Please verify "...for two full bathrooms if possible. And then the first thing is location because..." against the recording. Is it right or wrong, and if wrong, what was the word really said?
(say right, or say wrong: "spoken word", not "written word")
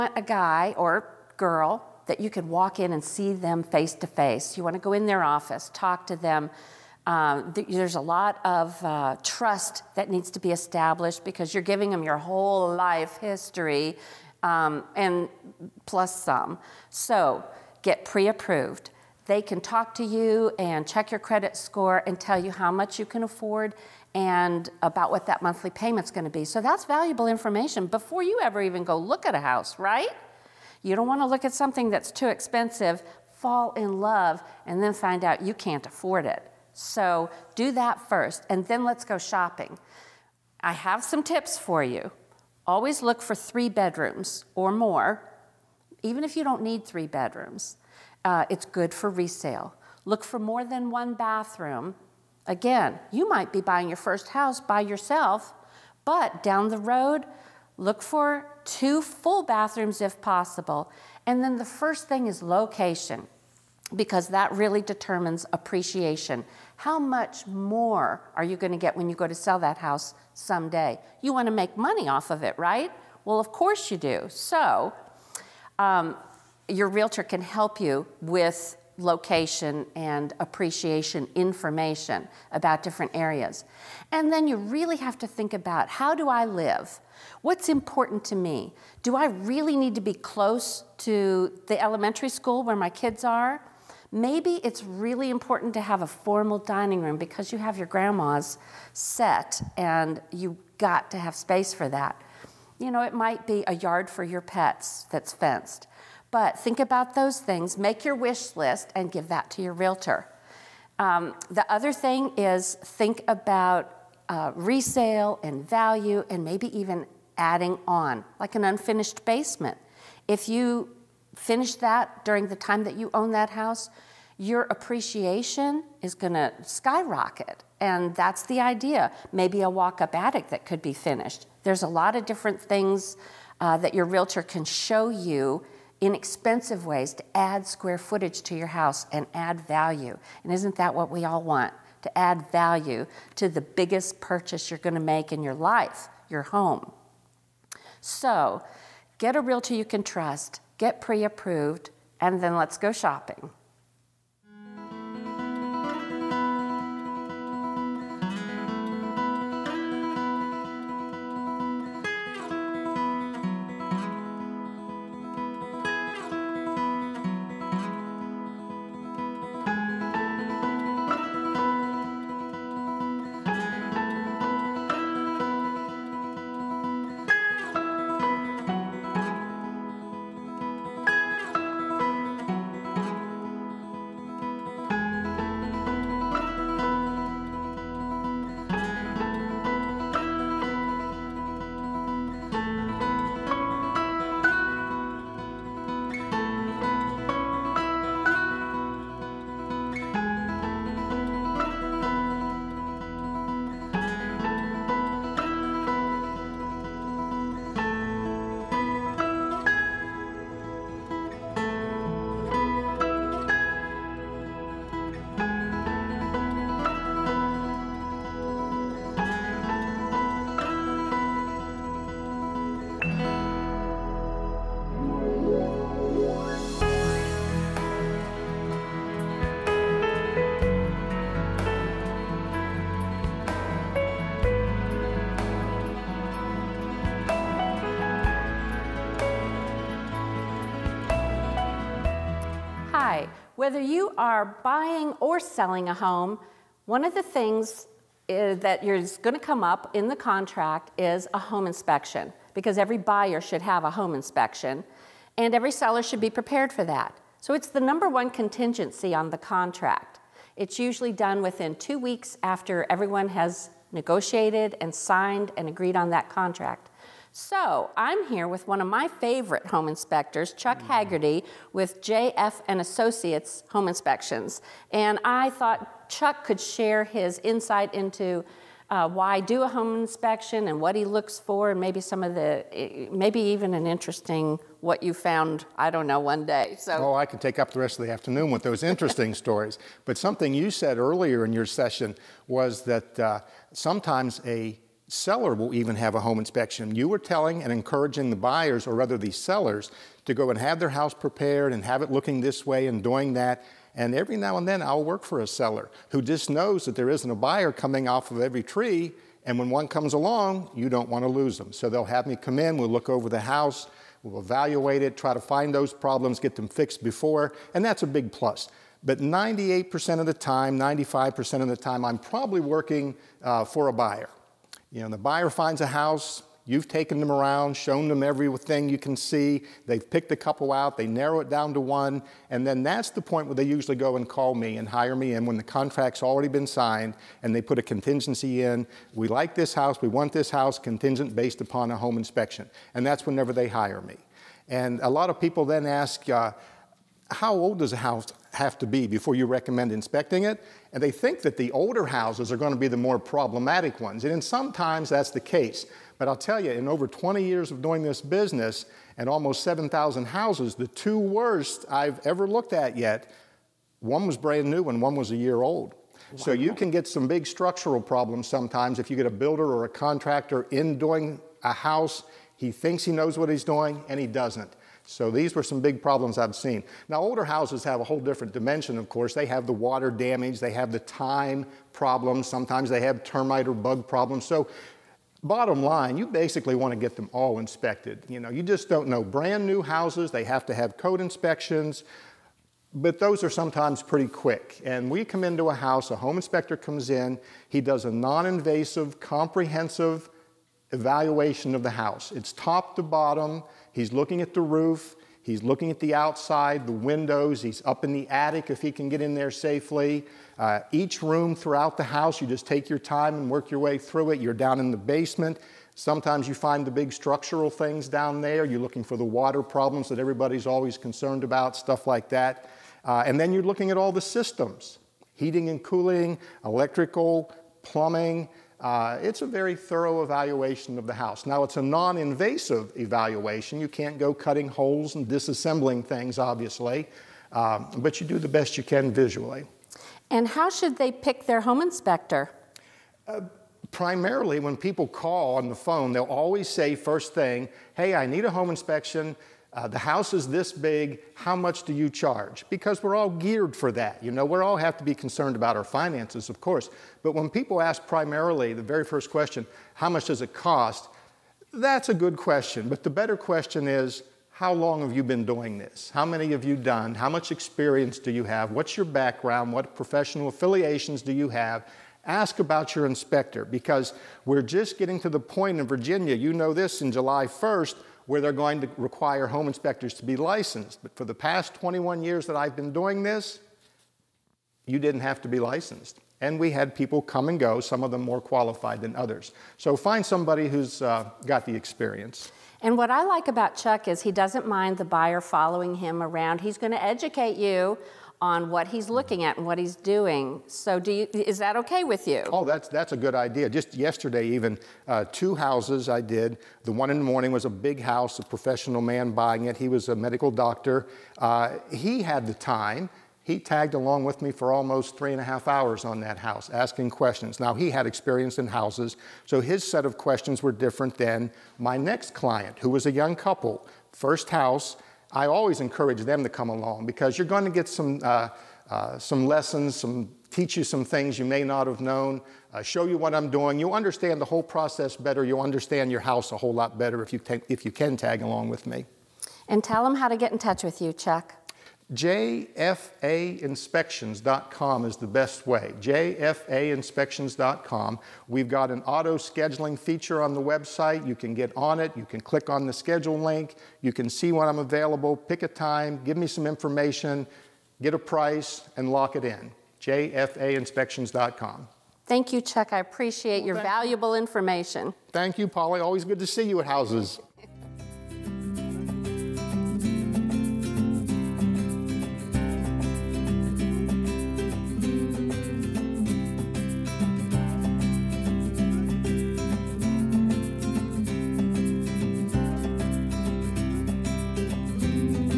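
right.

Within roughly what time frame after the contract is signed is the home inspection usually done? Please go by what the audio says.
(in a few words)
Two weeks.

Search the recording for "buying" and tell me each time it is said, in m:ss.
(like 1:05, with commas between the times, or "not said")
0:53, 4:04, 8:29.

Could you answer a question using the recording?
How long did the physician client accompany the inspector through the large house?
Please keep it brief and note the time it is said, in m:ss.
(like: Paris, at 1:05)
Three and a half hours, at 8:35.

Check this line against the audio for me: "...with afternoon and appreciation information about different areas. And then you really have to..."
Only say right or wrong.
wrong.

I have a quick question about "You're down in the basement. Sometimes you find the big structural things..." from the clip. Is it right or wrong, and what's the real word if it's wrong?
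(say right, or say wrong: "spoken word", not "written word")
right.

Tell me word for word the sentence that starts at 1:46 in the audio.
But think about those things, make your wish list, and give that to your realtor.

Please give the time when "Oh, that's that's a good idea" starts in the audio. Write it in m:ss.
8:22.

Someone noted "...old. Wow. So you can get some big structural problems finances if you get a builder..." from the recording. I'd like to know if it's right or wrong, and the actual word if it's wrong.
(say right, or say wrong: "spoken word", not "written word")
wrong: "sometimes", not "finances".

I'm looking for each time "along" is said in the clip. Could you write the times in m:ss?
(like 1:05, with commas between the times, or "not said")
5:10, 8:33, 8:46, 8:58.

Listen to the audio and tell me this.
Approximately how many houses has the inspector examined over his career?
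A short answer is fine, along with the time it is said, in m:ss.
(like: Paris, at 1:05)
7,000, at 5:59.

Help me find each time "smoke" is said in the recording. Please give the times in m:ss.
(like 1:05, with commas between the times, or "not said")
not said.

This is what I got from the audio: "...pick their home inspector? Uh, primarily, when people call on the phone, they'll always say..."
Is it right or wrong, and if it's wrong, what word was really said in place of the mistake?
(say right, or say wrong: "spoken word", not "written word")
right.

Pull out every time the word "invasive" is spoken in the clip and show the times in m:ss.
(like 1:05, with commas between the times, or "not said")
6:38, 7:12.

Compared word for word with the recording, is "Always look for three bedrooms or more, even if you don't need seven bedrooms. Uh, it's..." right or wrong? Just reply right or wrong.
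wrong.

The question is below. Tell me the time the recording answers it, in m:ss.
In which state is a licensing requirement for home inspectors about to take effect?
7:55.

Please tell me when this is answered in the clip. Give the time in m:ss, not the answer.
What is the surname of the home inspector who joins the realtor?
4:30.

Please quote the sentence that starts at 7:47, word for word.
How much experience do you have?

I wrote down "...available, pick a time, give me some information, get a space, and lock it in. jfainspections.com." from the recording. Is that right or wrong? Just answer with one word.
wrong.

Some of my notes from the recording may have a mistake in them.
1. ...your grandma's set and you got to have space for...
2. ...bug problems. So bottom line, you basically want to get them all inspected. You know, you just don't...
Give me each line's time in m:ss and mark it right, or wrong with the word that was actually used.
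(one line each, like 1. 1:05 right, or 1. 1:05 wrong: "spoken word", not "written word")
1. 1:37 right
2. 6:23 right.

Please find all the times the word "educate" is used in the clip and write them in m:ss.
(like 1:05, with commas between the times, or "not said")
8:17.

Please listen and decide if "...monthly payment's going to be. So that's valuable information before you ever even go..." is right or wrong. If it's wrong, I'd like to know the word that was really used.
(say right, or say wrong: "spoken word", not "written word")
right.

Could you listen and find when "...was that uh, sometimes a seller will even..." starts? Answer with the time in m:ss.
4:52.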